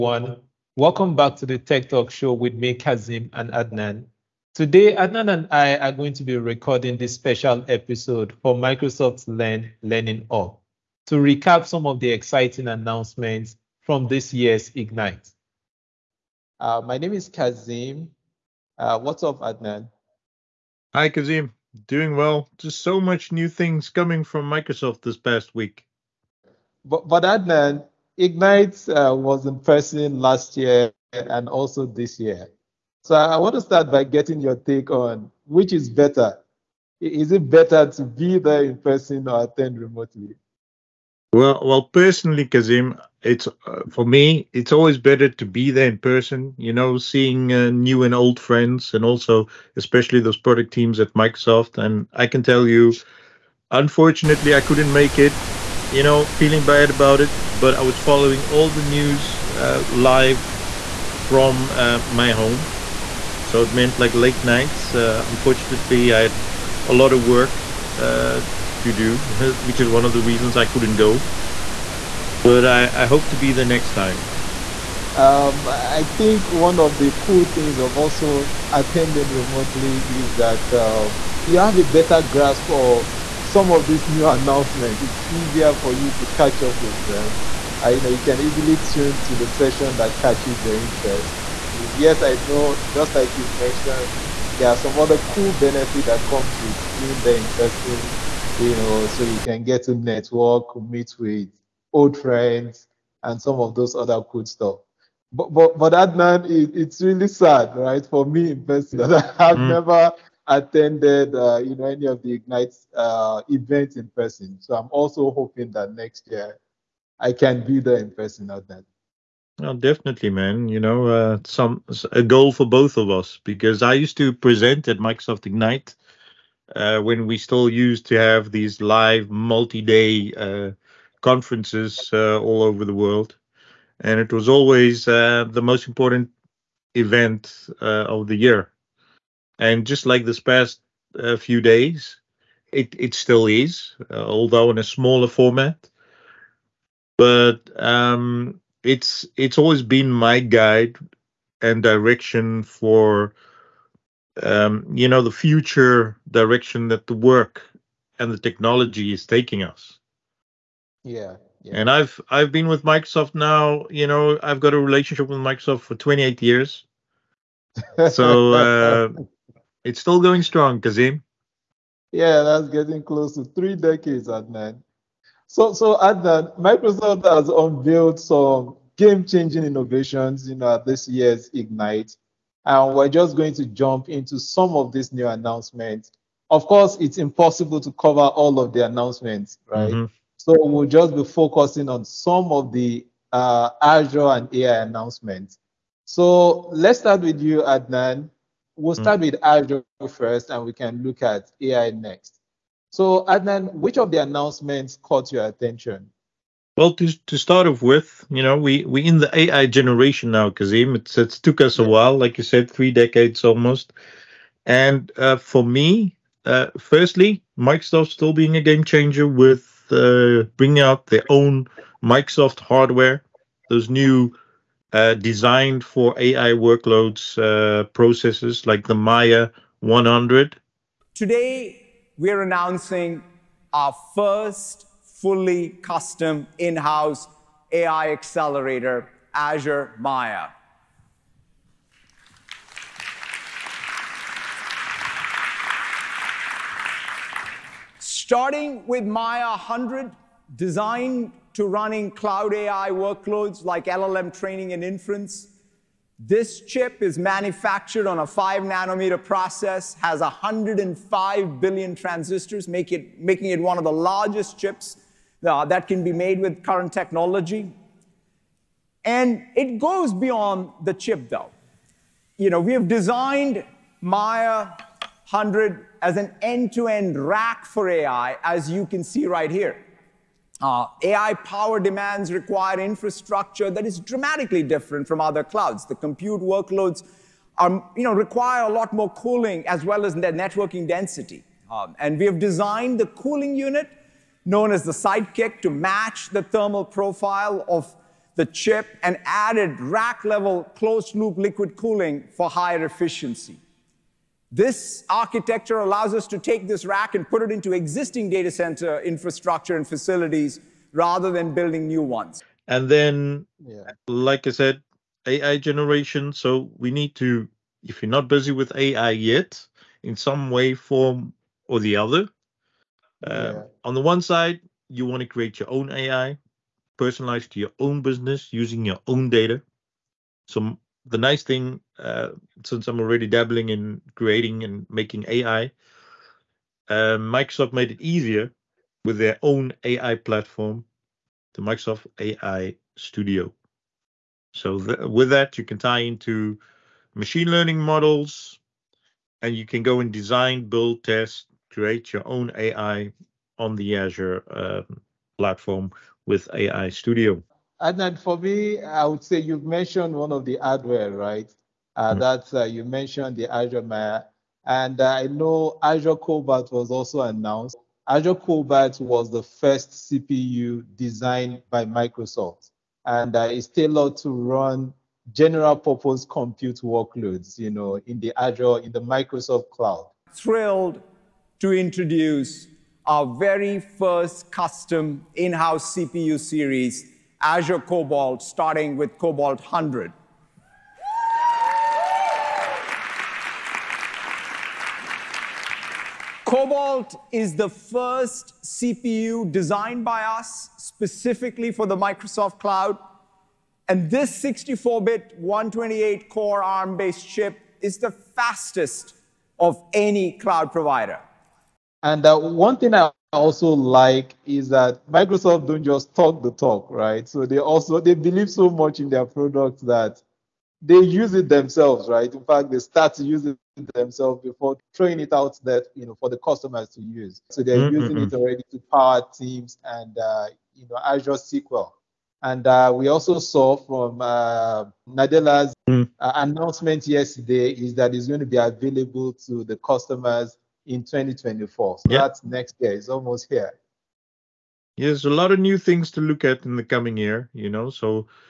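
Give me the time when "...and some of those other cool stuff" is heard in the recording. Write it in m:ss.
1:43.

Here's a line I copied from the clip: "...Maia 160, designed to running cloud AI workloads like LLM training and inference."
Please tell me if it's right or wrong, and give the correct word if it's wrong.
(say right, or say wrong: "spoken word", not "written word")
wrong: "100", not "160".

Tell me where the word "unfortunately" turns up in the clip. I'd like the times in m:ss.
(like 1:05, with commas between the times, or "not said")
0:53, 1:05.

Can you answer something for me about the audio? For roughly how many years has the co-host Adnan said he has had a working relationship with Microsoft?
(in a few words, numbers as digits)
28.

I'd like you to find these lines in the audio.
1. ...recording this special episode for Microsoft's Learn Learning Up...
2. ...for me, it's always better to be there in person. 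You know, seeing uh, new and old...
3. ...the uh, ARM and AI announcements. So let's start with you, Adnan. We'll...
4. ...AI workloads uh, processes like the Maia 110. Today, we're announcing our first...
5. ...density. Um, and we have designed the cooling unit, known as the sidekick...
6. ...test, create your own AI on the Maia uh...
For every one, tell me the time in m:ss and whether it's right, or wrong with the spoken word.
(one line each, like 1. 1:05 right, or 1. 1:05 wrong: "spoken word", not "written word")
1. 0:06 right
2. 0:43 right
3. 3:12 wrong: "Azure", not "ARM"
4. 3:46 wrong: "100", not "110"
5. 4:50 right
6. 5:51 wrong: "Azure", not "Maia".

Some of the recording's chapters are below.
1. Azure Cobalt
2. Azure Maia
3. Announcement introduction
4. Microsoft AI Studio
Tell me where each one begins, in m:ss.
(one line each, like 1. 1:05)
1. 5:57
2. 3:15
3. 2:54
4. 5:12.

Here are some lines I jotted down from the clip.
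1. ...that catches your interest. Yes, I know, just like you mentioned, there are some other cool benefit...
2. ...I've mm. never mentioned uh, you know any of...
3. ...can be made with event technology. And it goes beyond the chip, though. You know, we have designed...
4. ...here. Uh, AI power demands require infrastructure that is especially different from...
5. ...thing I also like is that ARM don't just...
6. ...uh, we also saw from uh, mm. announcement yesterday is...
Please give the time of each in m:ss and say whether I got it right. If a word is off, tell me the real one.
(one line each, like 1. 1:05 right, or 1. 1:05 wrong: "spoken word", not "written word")
1. 1:29 right
2. 1:49 wrong: "attended", not "mentioned"
3. 4:25 wrong: "current", not "event"
4. 4:39 wrong: "dramatically", not "especially"
5. 6:52 wrong: "Microsoft", not "ARM"
6. 7:12 right.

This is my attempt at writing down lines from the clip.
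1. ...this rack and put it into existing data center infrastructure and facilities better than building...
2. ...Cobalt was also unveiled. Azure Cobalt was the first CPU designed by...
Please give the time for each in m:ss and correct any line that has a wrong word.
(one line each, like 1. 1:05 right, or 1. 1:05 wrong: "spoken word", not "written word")
1. 5:06 wrong: "rather", not "better"
2. 6:06 wrong: "announced", not "unveiled".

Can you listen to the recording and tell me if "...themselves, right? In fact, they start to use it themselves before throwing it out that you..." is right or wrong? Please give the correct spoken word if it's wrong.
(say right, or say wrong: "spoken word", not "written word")
right.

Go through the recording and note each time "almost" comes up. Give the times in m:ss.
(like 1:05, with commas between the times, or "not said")
3:33, 7:23.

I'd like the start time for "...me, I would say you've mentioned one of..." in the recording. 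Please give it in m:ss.
5:58.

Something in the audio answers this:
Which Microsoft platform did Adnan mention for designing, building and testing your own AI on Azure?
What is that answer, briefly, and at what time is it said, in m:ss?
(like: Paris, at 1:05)
Microsoft AI Studio, at 5:41.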